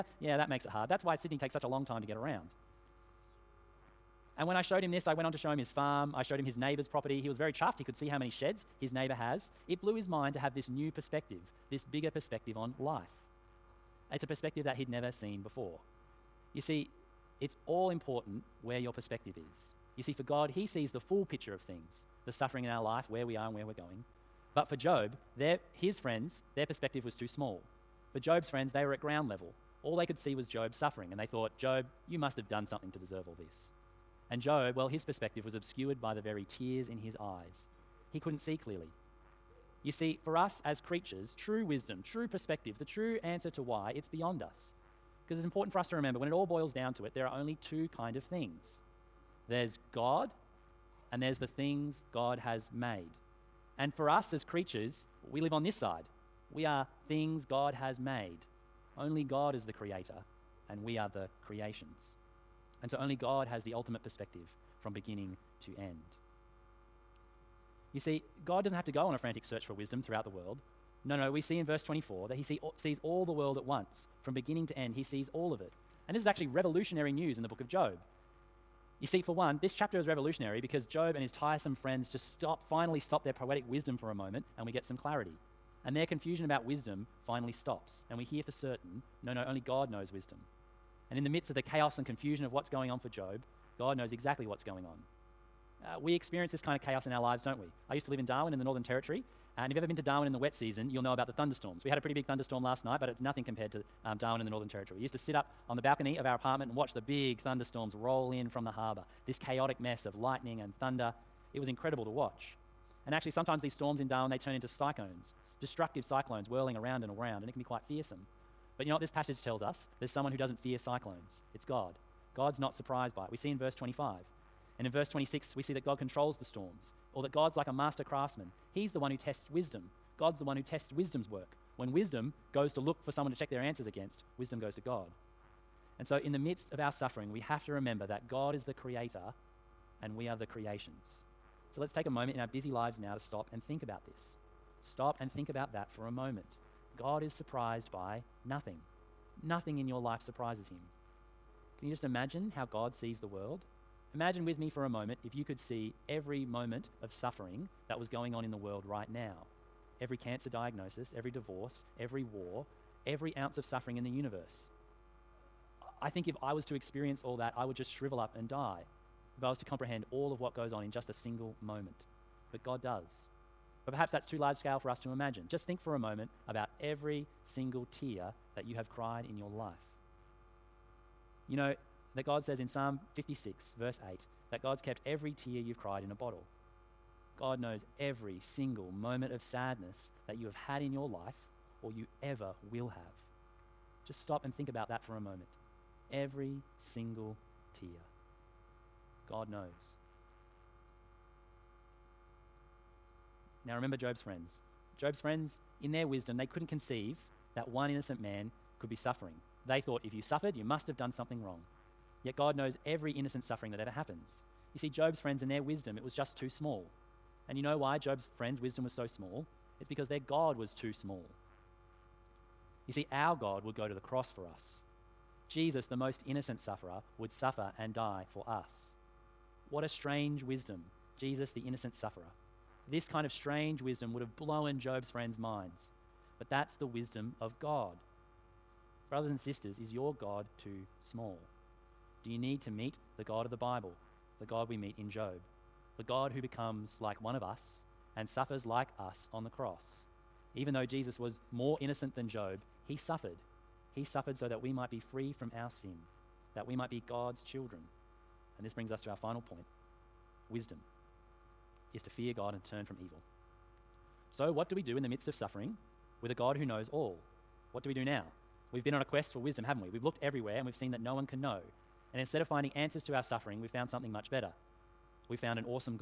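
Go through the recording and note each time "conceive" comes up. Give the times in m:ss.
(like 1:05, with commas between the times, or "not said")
3:26.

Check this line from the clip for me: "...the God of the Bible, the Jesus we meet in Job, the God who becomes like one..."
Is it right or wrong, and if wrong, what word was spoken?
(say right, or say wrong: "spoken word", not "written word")
wrong: "God", not "Jesus".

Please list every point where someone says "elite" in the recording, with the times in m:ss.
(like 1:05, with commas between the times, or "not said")
not said.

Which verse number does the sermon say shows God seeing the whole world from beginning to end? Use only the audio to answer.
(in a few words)
24.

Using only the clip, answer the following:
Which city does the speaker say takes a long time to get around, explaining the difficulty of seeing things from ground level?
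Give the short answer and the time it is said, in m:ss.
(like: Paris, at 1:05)
Sydney, at 0:01.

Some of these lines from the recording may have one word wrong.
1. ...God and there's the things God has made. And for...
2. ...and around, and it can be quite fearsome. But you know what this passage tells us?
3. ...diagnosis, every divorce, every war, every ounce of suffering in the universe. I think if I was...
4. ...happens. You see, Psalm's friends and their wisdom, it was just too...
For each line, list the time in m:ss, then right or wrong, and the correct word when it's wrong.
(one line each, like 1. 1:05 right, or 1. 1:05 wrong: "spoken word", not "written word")
1. 0:49 right
2. 1:57 right
3. 2:40 right
4. 3:33 wrong: "Job", not "Psalm".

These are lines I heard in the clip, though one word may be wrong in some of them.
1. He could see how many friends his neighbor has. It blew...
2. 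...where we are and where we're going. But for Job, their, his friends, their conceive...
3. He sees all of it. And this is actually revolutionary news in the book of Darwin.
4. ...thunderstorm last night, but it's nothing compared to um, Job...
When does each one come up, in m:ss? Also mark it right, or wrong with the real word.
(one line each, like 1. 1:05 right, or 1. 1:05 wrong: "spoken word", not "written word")
1. 0:07 wrong: "sheds", not "friends"
2. 0:23 wrong: "perspective", not "conceive"
3. 1:14 wrong: "Job", not "Darwin"
4. 1:42 wrong: "Darwin", not "Job".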